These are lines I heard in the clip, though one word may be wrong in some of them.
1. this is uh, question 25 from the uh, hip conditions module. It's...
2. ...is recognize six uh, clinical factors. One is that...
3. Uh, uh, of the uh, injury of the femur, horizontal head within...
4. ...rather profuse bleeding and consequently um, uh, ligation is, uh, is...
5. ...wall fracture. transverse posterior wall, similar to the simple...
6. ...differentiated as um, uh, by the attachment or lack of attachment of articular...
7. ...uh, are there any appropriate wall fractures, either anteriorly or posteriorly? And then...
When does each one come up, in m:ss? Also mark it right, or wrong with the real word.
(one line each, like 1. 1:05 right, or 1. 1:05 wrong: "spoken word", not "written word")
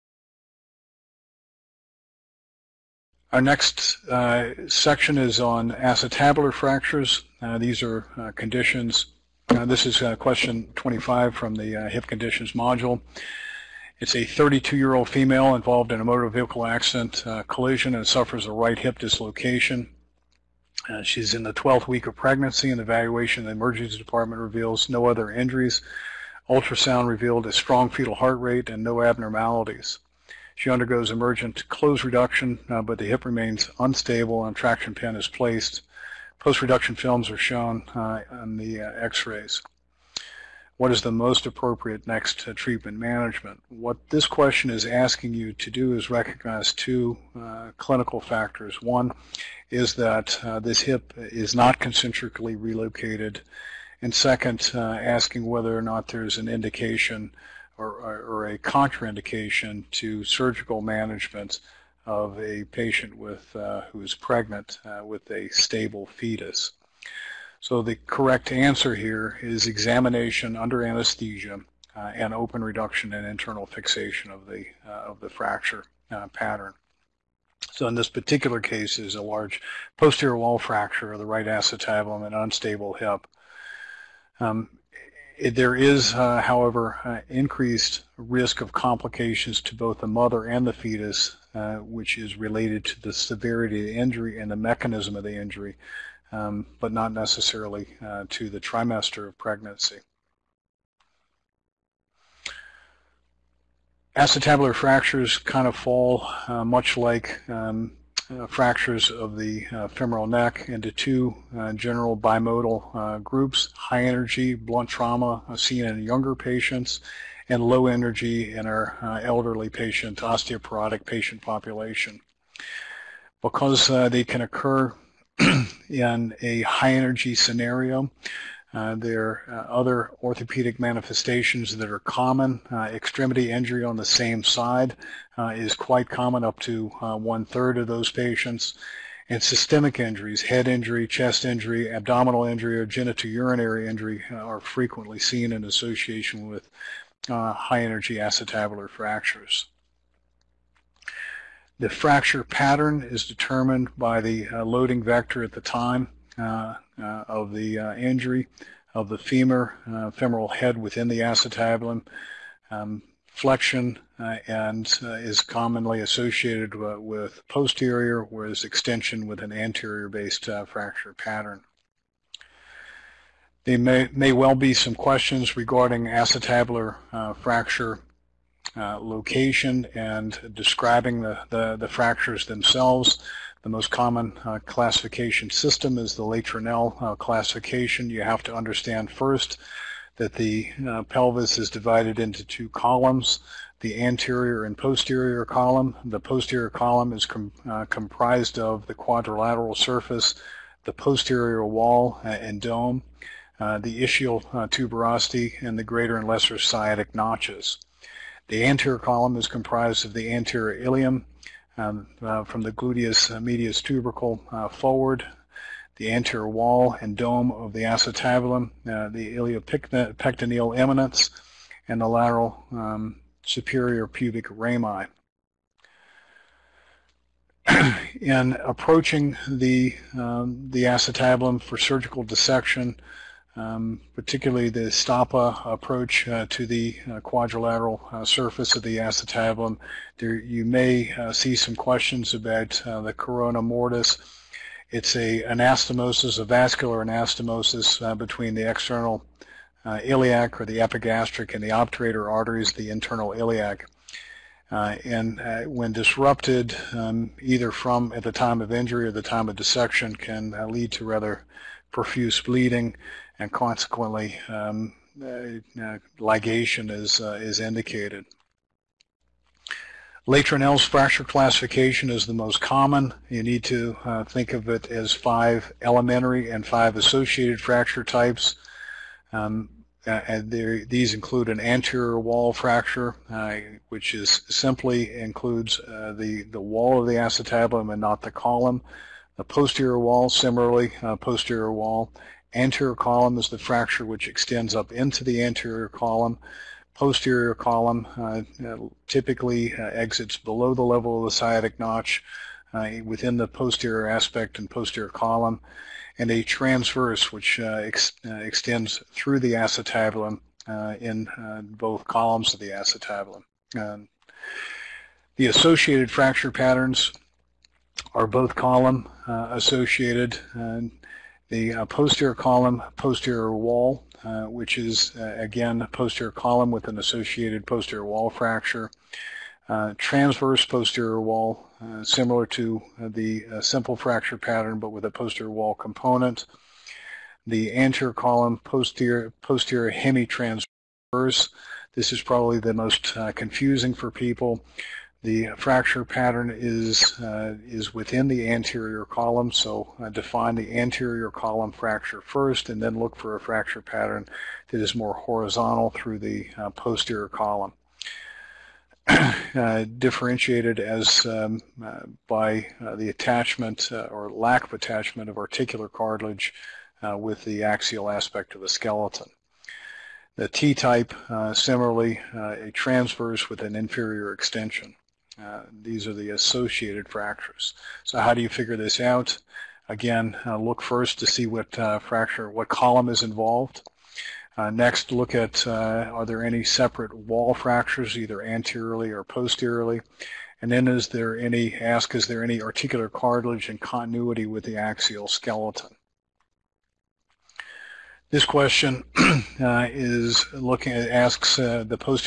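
1. 0:09 right
2. 0:45 wrong: "two", not "six"
3. 2:36 wrong: "femoral", not "horizontal"
4. 4:21 right
5. 5:28 right
6. 5:59 right
7. 6:25 wrong: "separate", not "appropriate".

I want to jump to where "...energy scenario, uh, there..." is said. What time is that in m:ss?
2:06.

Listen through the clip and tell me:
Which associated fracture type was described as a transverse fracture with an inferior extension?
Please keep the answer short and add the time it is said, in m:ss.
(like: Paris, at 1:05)
T-type, at 6:10.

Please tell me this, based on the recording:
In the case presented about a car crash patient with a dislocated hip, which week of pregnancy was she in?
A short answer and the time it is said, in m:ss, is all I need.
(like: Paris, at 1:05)
12th week, at 0:21.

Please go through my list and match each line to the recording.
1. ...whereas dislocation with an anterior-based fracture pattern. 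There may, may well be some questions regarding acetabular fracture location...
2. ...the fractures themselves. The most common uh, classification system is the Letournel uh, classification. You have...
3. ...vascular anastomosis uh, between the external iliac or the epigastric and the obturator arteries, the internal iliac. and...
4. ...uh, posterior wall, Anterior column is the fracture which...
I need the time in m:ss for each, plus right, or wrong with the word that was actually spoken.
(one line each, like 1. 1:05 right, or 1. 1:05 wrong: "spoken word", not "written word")
1. 2:48 wrong: "extension", not "dislocation"
2. 3:01 right
3. 4:06 right
4. 4:51 right.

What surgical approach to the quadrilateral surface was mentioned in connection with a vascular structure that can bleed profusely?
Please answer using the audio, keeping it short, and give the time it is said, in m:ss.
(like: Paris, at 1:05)
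Stoppa approach, at 3:54.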